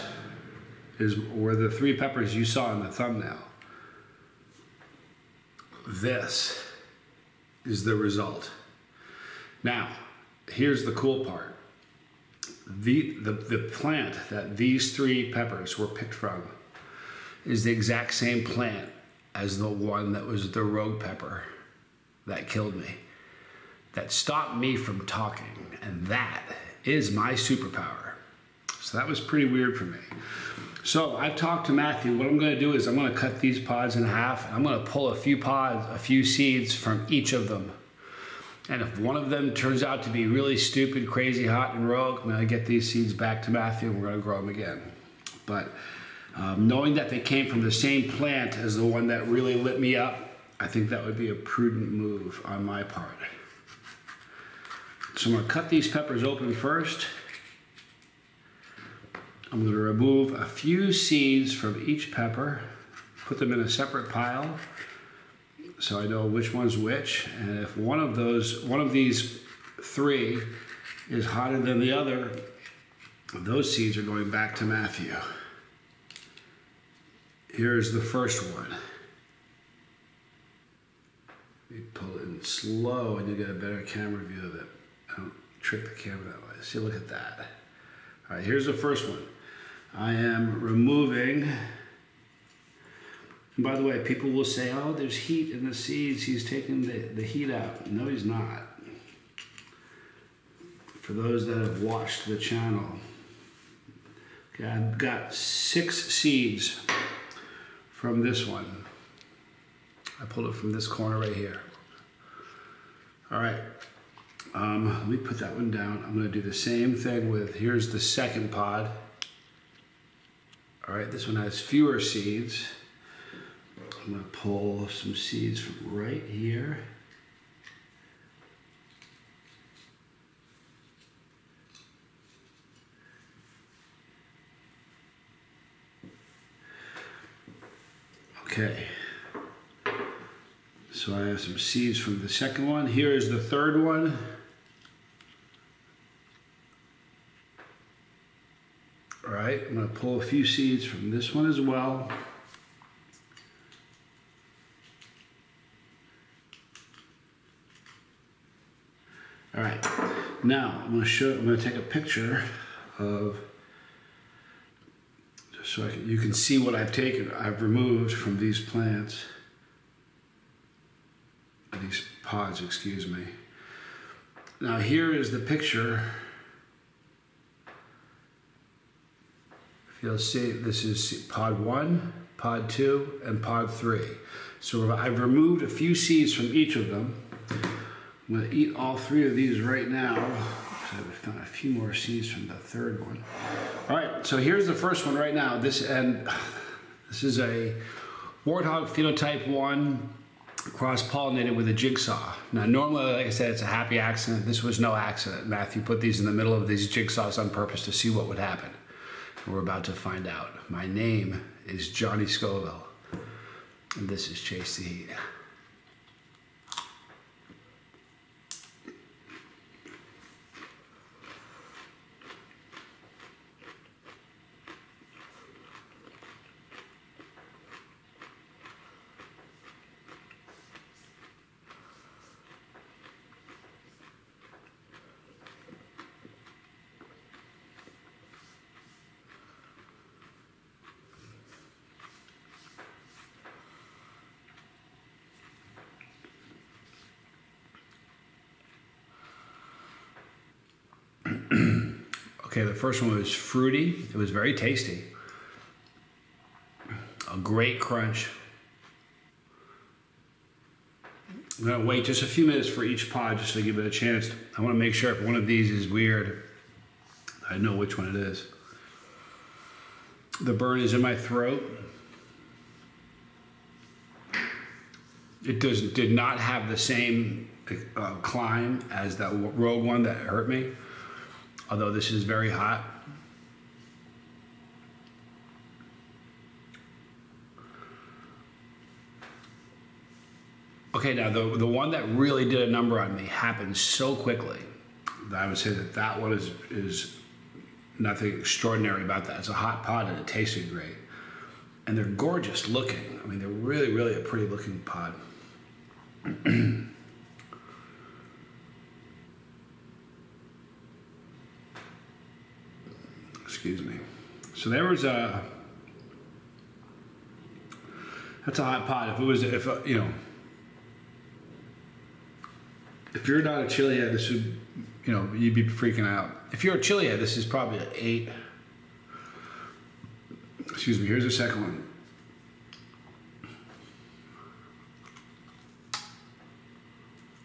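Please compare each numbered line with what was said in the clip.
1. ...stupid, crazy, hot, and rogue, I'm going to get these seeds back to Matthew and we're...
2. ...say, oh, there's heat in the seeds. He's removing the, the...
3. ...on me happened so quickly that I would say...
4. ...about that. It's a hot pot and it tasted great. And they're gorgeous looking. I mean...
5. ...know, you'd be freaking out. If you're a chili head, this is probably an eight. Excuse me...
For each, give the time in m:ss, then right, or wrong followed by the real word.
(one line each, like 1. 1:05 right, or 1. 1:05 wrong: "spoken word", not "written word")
1. 0:40 right
2. 1:34 wrong: "taking", not "removing"
3. 4:52 right
4. 4:59 right
5. 5:25 right.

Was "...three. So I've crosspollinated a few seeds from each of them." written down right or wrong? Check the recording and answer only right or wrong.
wrong.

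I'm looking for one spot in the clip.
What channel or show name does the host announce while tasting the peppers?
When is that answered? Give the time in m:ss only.
3:34.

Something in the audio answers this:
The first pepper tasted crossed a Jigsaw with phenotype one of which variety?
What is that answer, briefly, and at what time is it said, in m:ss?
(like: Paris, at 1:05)
Warthog, at 3:18.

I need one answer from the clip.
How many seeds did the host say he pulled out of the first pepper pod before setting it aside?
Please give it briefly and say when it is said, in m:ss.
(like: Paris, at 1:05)
6, at 1:45.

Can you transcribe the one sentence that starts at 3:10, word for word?
I've found a few more seeds from the third one.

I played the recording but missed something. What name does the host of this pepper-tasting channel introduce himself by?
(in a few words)
Johnny Scoville.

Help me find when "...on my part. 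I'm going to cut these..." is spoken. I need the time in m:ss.
0:52.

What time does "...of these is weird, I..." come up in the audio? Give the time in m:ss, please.
4:25.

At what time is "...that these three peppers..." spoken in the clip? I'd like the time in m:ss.
0:14.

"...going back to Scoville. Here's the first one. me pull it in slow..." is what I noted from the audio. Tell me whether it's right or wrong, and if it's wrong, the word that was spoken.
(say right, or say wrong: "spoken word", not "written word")
wrong: "Matthew", not "Scoville".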